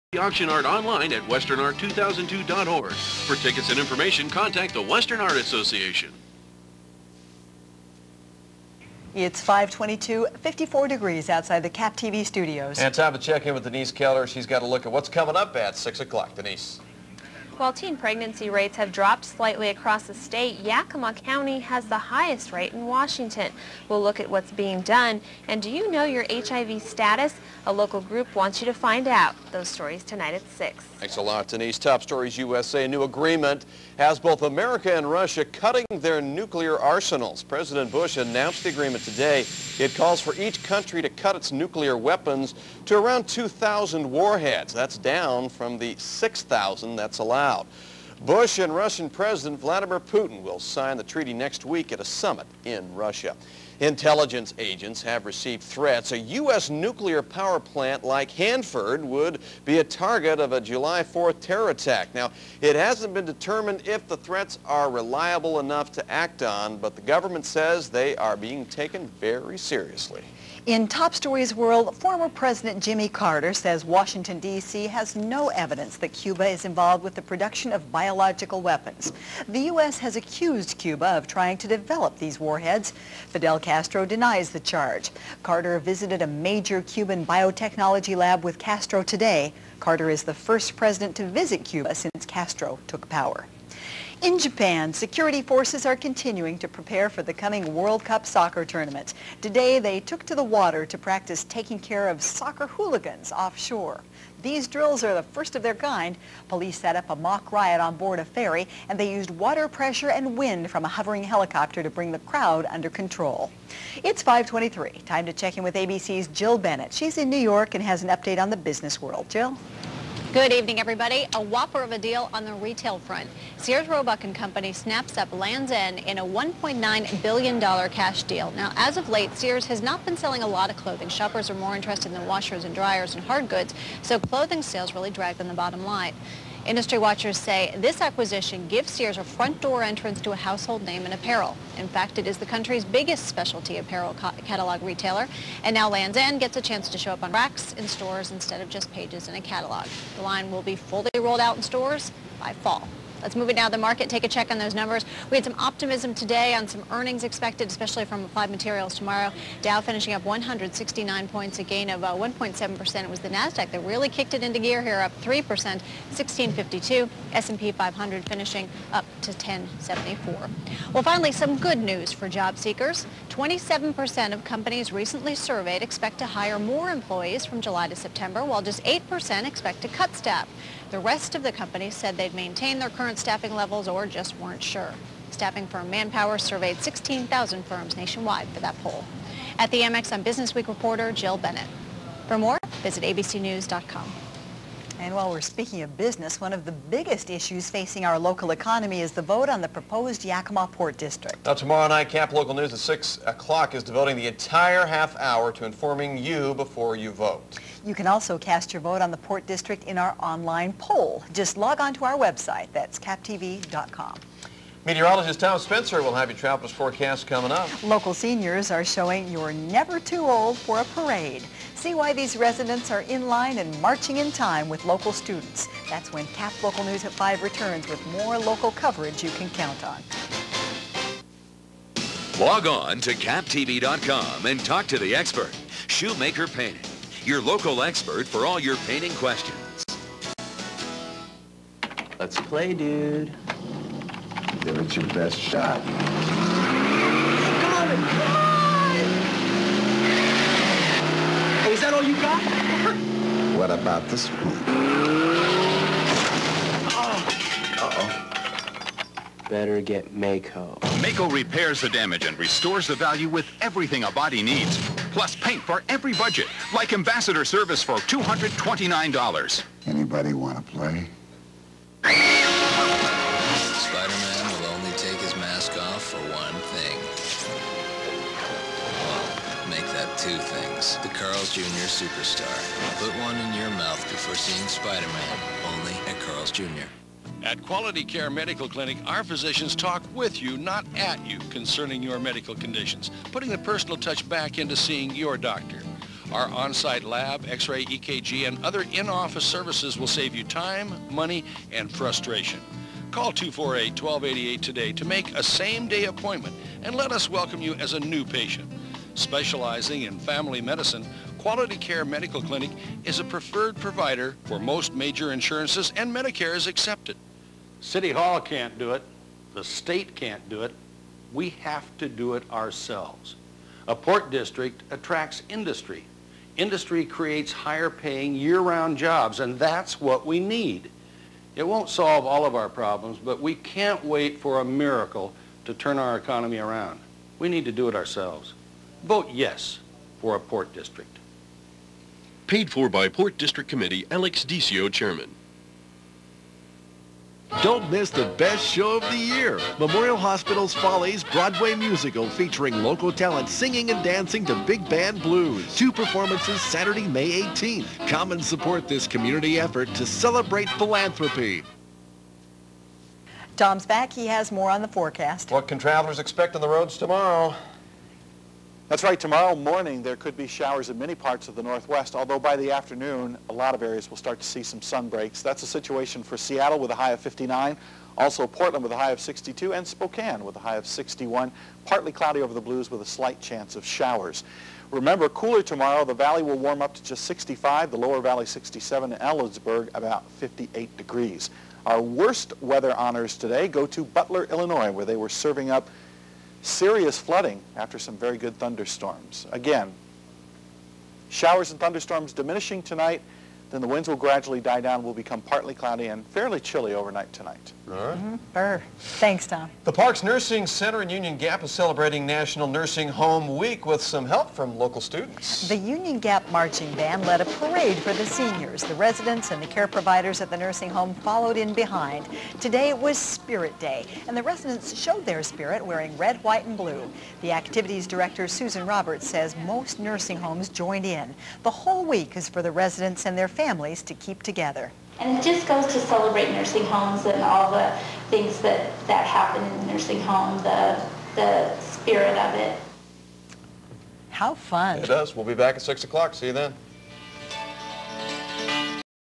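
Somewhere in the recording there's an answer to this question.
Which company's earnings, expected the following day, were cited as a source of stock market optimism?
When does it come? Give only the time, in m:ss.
2:38.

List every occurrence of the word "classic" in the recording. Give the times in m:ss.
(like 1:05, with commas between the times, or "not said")
not said.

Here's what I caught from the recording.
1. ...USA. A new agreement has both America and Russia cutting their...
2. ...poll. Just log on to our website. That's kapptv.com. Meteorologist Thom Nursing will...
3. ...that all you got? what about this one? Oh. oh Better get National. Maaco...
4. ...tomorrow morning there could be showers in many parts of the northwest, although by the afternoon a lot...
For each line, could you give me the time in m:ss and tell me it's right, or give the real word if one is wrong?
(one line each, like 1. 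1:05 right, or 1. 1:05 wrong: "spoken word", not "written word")
1. 0:32 right
2. 3:30 wrong: "Spencer", not "Nursing"
3. 4:11 wrong: "Maaco", not "National"
4. 6:09 right.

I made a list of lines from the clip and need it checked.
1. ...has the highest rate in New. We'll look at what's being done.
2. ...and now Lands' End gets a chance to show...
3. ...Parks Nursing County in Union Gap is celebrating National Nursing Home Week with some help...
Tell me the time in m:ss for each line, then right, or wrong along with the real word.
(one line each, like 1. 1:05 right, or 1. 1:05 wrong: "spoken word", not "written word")
1. 0:21 wrong: "Washington", not "New"
2. 2:25 right
3. 6:49 wrong: "Center", not "County".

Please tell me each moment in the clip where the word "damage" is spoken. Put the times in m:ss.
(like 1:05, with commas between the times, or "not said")
4:21.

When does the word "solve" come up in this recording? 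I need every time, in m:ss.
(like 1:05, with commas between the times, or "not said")
5:31.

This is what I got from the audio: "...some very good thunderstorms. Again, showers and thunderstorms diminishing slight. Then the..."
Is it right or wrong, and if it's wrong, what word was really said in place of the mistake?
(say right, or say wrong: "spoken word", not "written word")
wrong: "tonight", not "slight".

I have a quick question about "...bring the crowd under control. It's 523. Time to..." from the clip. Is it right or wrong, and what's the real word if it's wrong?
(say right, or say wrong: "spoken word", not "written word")
right.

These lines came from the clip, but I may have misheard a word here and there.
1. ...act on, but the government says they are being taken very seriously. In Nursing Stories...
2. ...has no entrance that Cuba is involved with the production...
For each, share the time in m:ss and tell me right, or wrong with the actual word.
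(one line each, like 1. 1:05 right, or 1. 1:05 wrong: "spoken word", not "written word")
1. 1:06 wrong: "Top", not "Nursing"
2. 1:14 wrong: "evidence", not "entrance".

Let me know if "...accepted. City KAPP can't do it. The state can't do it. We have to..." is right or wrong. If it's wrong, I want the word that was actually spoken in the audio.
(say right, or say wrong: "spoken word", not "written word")
wrong: "Hall", not "KAPP".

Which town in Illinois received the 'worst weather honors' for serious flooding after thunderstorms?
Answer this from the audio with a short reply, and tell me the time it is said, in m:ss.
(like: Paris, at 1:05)
Butler, at 6:34.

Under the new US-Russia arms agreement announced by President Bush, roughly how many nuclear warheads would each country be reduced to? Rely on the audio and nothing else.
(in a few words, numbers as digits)
2,000.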